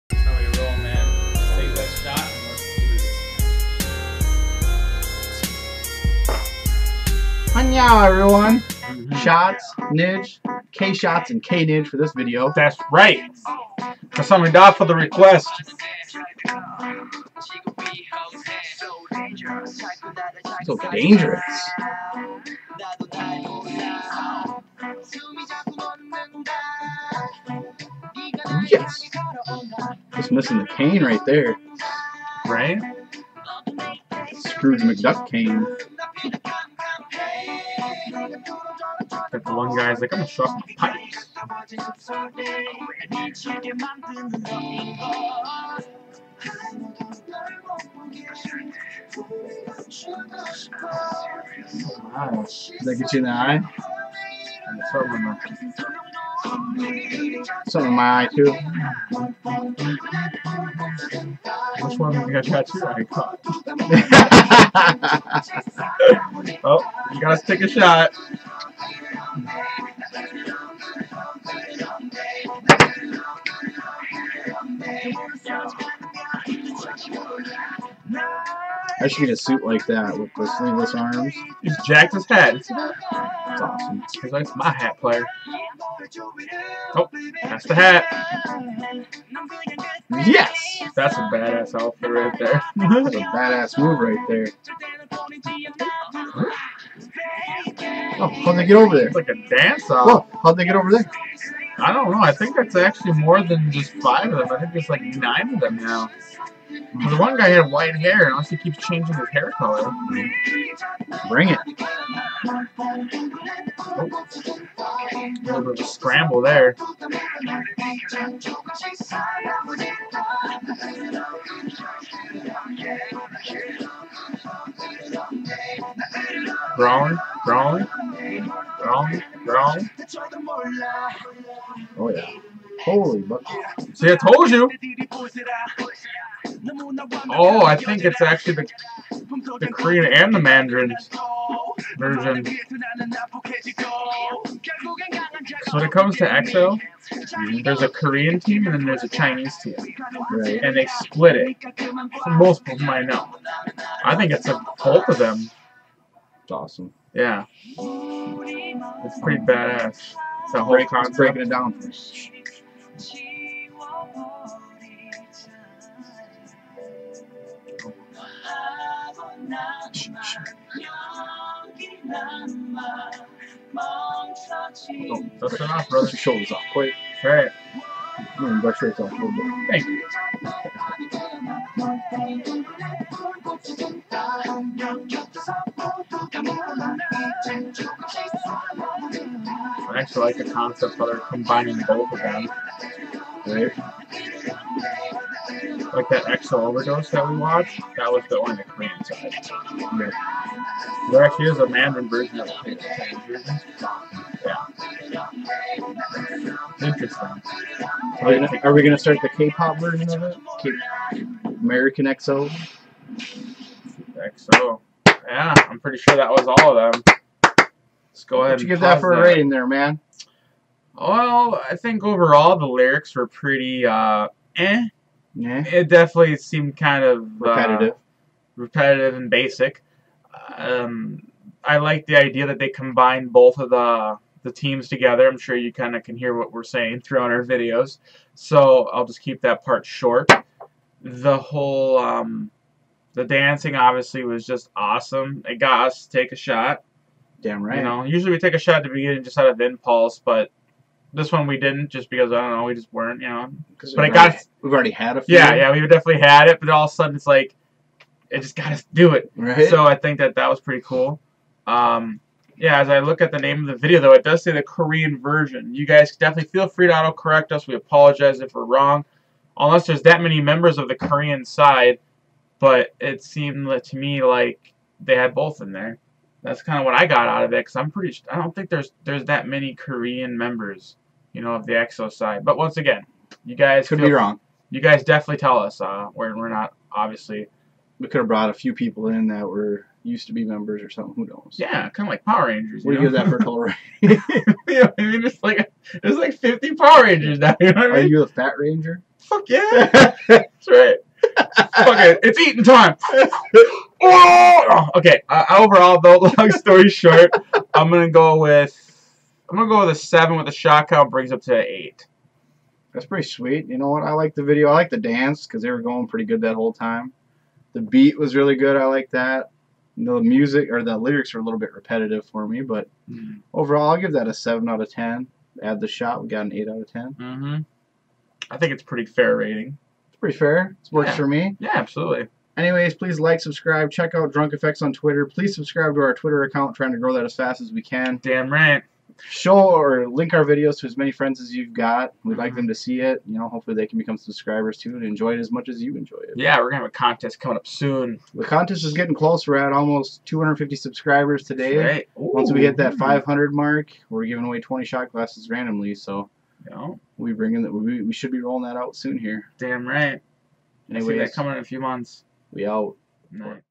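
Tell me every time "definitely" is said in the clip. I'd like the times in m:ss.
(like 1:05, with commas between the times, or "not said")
3:45, 4:15, 4:26, 4:45.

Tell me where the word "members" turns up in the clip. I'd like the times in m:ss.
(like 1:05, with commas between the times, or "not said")
4:30, 4:40, 4:50.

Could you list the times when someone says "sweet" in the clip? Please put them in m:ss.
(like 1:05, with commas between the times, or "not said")
5:13.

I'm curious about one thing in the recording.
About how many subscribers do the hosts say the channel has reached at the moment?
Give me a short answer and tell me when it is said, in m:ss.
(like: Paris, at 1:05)
250, at 5:50.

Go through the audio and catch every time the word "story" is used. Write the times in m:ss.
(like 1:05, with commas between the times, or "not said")
5:06.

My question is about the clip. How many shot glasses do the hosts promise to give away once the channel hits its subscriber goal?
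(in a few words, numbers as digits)
20.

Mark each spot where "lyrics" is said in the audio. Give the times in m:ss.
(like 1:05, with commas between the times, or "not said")
3:42, 5:20.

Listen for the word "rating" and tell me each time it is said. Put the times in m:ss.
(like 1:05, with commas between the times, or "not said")
3:39, 5:29.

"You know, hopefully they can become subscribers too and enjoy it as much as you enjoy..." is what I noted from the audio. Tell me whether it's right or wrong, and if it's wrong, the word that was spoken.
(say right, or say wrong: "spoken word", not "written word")
right.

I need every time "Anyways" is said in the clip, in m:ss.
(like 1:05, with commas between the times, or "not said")
5:32, 6:00.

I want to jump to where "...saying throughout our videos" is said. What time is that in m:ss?
3:56.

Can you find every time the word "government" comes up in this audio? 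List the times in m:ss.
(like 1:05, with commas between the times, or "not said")
not said.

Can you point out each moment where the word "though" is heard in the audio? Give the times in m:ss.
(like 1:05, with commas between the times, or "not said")
4:23, 5:06.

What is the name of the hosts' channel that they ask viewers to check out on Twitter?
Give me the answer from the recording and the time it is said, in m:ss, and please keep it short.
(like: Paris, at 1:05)
DrunkFX, at 5:34.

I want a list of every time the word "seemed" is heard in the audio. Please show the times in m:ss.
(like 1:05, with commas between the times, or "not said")
3:46, 4:33.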